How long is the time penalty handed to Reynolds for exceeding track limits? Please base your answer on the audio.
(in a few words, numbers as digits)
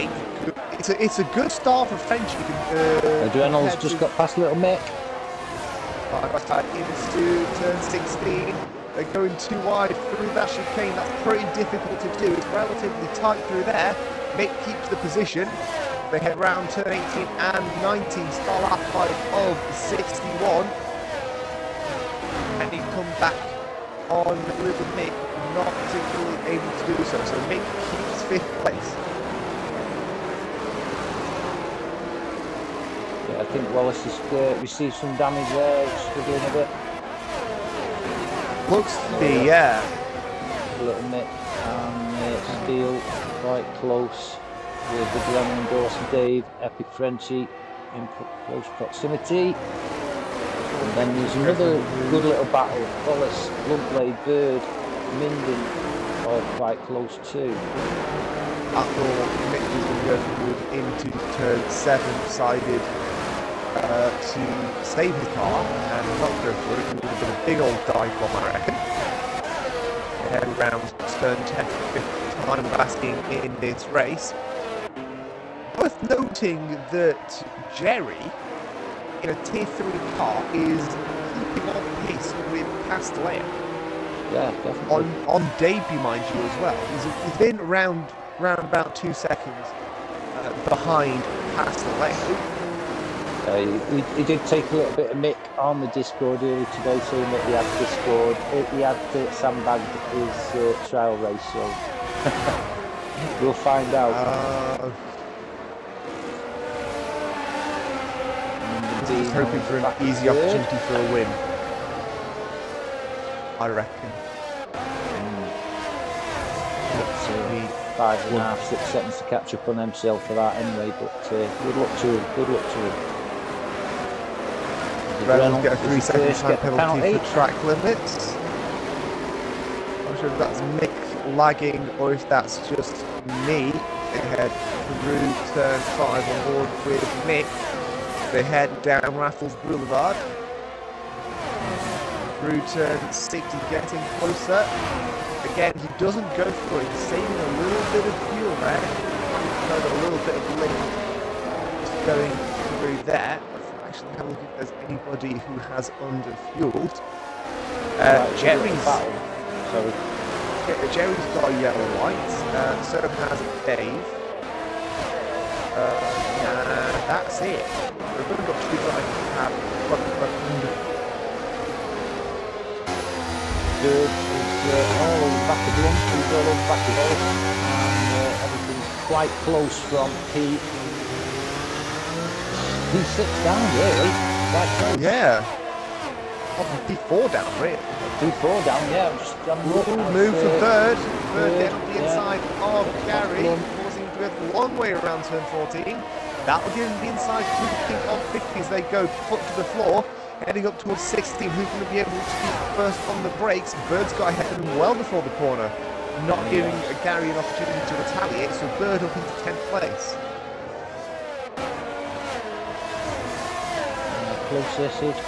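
3 seconds.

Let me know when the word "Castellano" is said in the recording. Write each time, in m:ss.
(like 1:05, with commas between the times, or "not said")
1:22, 1:31.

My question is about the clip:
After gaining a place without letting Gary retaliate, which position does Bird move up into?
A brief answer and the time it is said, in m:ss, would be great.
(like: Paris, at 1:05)
10th, at 3:29.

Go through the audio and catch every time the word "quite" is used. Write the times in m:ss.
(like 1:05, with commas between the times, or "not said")
0:43, 0:56, 2:59.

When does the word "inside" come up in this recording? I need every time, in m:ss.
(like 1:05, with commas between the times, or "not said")
3:12, 3:17.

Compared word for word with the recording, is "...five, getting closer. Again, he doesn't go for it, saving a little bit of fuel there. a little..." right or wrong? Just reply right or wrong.
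wrong.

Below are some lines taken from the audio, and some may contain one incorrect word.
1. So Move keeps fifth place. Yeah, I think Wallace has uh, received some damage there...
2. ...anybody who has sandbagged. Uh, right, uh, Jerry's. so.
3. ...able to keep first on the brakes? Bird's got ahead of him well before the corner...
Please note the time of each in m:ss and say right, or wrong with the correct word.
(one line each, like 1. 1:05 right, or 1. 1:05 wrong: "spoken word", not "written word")
1. 0:27 wrong: "Mick", not "Move"
2. 2:34 wrong: "underfueled", not "sandbagged"
3. 3:21 right.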